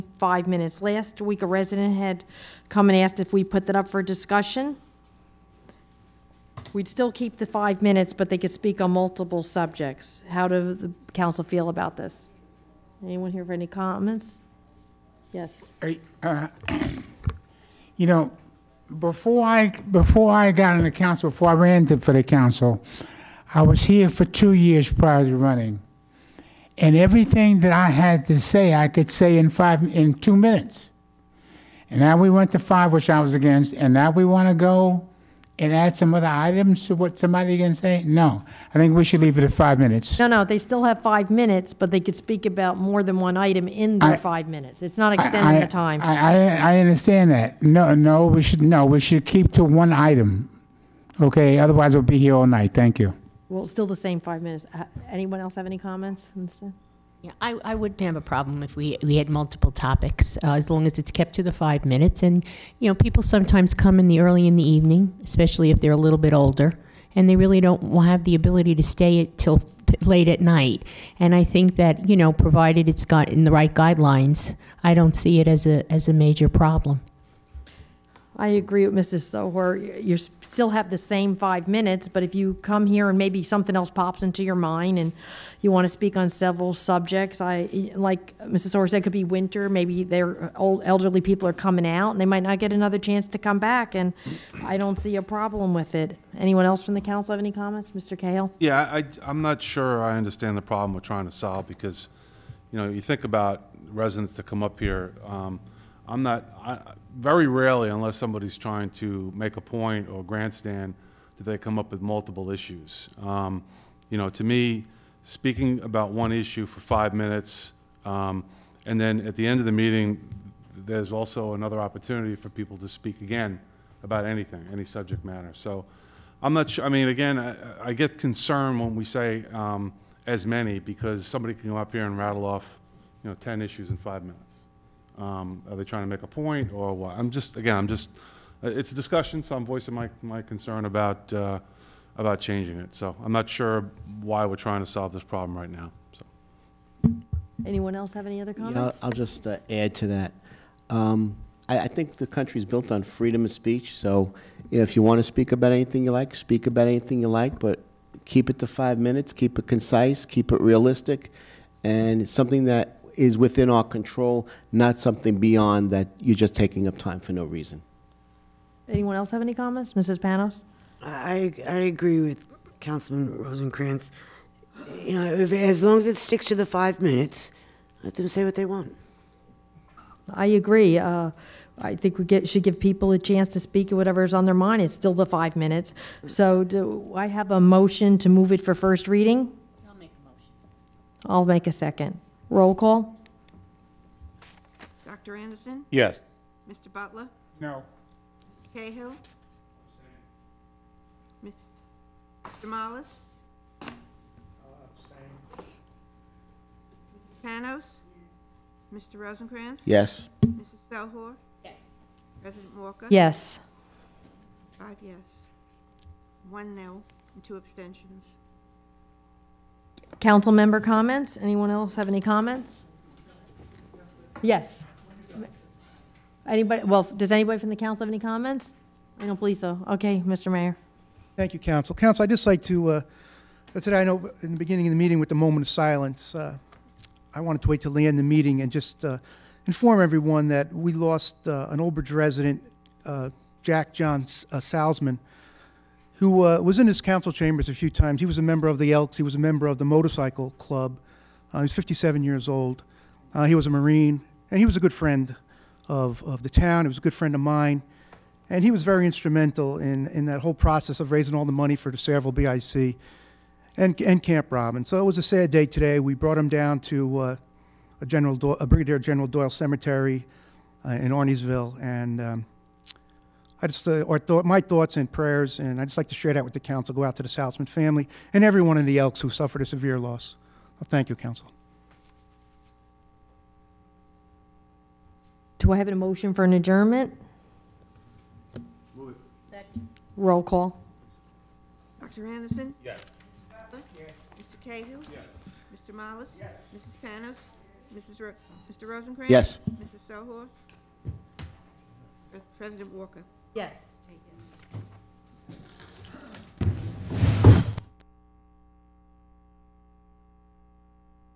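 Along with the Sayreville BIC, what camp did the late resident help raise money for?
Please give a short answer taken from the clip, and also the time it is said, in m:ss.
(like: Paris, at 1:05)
Camp Robin, at 4:24.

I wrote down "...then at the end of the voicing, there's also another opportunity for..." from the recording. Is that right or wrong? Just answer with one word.
wrong.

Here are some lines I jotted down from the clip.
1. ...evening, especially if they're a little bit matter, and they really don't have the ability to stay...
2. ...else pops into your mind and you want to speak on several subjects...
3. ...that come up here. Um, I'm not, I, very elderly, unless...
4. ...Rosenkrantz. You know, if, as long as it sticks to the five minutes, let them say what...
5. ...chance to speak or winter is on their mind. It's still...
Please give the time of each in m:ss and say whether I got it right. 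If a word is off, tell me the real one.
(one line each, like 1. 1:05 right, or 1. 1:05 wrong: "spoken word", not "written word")
1. 1:04 wrong: "older", not "matter"
2. 1:23 right
3. 1:44 wrong: "rarely", not "elderly"
4. 2:53 right
5. 3:03 wrong: "whatever", not "winter".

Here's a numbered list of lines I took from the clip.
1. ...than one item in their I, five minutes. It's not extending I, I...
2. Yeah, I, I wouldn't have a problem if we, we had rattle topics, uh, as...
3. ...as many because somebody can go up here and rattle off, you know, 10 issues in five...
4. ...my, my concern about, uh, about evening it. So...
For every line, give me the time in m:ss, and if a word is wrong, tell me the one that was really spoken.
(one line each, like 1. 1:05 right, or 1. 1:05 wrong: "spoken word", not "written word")
1. 0:43 right
2. 0:57 wrong: "multiple", not "rattle"
3. 2:10 right
4. 2:19 wrong: "changing", not "evening".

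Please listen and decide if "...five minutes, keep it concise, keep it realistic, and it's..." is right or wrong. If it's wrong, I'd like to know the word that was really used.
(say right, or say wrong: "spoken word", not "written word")
right.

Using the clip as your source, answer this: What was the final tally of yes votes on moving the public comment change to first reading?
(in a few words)
5.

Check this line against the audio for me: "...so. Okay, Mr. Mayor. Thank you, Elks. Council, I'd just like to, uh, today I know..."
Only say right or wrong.
wrong.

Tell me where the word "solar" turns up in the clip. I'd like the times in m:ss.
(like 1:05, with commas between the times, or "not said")
not said.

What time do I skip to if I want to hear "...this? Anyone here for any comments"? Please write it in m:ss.
0:11.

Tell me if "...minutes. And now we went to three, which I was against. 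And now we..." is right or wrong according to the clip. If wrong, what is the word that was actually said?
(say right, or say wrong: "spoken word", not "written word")
wrong: "five", not "three".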